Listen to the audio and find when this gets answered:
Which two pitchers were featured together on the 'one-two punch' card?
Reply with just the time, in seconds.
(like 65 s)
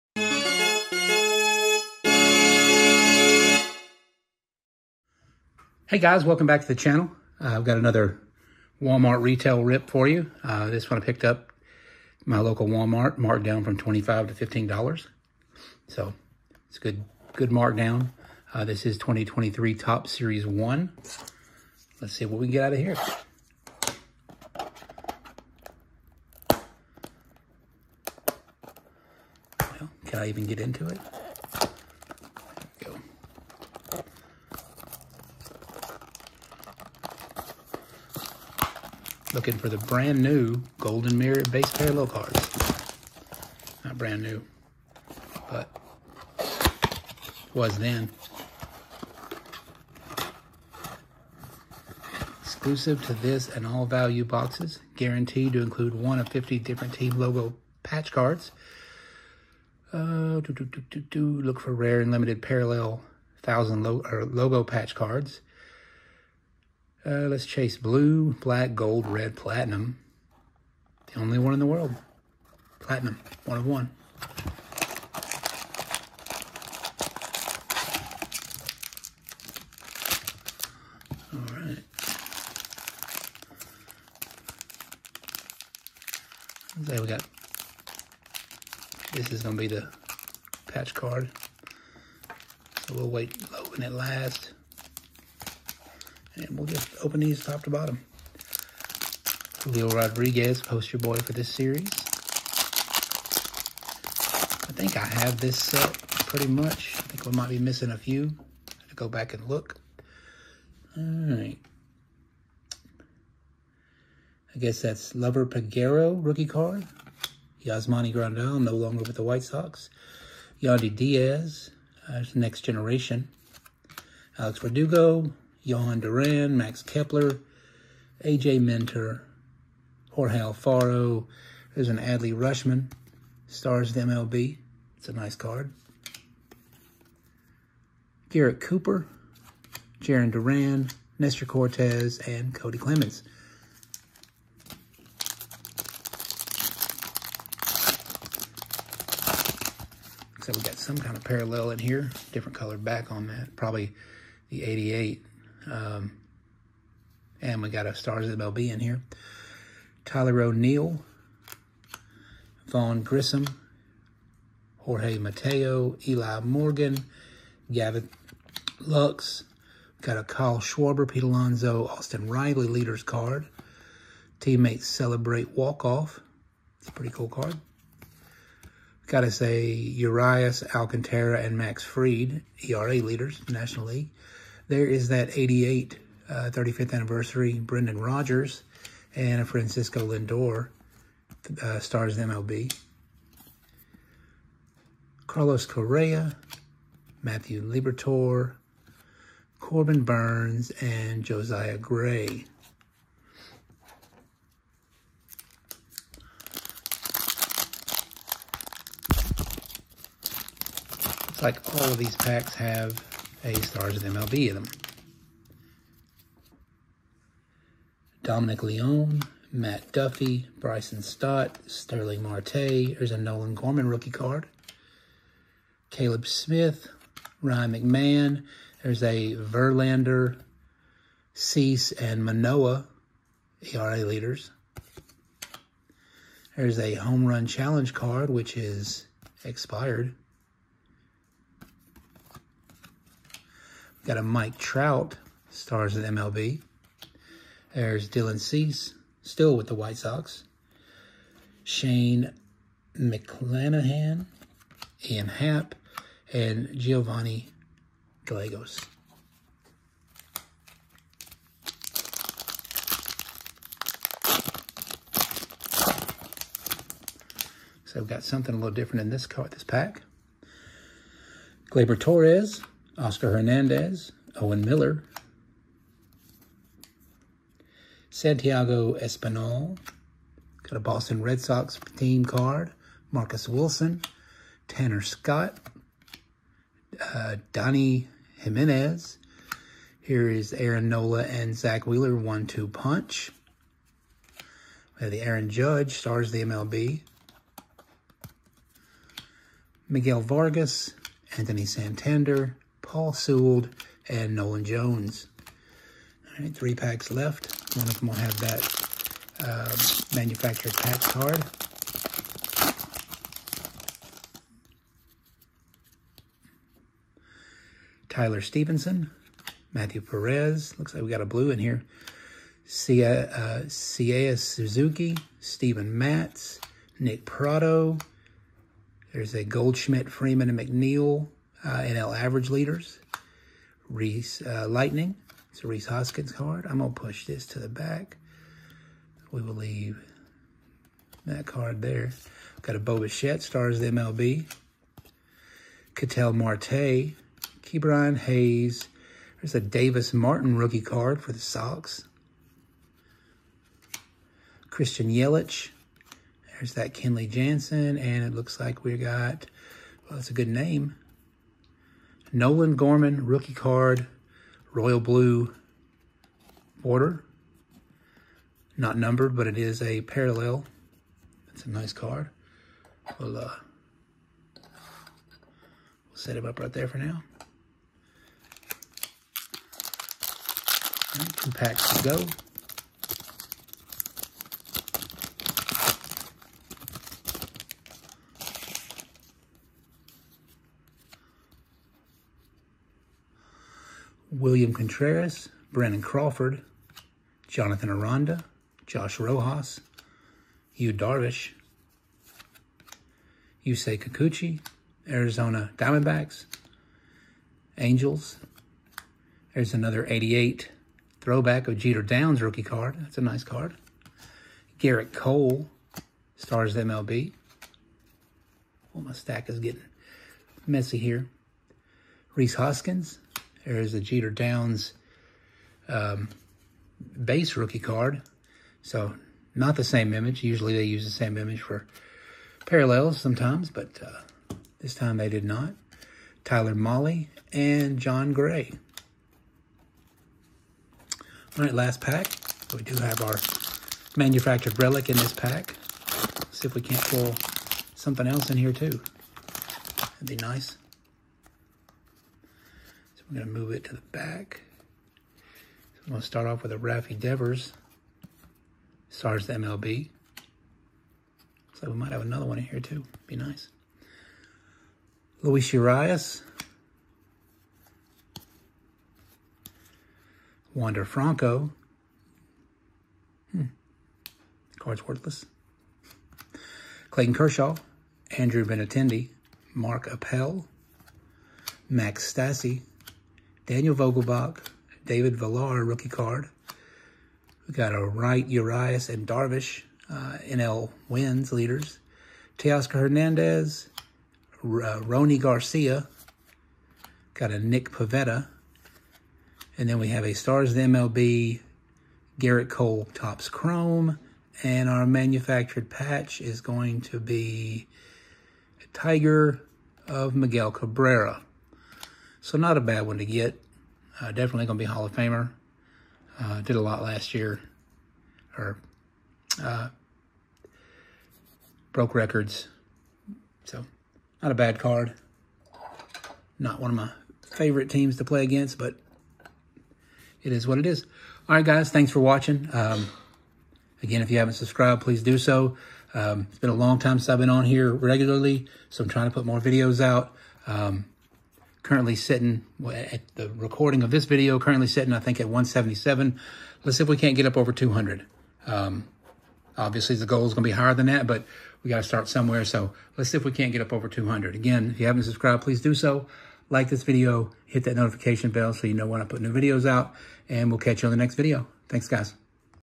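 290 s.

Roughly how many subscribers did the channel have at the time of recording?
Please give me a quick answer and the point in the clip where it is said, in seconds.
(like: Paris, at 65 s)
177, at 545 s.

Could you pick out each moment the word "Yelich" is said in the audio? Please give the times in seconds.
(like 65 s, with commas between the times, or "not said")
355 s.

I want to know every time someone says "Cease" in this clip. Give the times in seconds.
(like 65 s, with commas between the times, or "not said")
231 s, 248 s.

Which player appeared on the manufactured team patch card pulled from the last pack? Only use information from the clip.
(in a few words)
Miguel Cabrera.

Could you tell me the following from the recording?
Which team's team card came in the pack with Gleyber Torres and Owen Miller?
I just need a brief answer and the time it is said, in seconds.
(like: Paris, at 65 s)
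Boston Red Sox, at 280 s.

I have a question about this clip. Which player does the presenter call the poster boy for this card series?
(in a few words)
Julio Rodriguez.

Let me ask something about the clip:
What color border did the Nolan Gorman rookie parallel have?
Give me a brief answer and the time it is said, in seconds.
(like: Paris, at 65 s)
Royal blue, at 364 s.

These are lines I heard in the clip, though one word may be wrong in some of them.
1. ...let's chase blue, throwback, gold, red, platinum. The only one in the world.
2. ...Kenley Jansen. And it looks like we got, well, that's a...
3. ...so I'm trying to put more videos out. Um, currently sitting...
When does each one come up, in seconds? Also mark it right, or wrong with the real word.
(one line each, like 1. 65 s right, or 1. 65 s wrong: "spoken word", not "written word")
1. 67 s wrong: "black", not "throwback"
2. 356 s right
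3. 538 s right.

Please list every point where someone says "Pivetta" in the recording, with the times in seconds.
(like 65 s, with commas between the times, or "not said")
497 s.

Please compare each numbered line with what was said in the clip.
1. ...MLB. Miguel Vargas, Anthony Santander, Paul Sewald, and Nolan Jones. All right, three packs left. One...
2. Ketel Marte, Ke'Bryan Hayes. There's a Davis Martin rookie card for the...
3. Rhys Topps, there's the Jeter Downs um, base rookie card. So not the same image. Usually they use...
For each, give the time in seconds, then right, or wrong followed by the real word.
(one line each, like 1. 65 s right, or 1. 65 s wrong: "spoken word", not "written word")
1. 296 s right
2. 345 s right
3. 422 s wrong: "Hoskins", not "Topps".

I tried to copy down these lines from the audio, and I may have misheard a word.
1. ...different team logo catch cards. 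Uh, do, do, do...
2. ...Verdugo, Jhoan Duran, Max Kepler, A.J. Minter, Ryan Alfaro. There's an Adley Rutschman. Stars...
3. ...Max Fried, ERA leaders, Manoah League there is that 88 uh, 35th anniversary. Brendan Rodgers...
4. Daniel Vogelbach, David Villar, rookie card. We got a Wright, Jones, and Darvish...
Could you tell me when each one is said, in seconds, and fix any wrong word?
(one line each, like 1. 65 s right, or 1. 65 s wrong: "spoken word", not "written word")
1. 56 s wrong: "patch", not "catch"
2. 124 s wrong: "Jorge", not "Ryan"
3. 181 s wrong: "National", not "Manoah"
4. 483 s wrong: "Urias", not "Jones".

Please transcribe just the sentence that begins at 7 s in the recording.
Uh, I've got another Walmart retail rip for you.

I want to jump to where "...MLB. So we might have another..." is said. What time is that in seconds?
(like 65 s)
459 s.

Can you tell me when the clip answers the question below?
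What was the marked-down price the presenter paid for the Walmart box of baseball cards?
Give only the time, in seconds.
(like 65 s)
14 s.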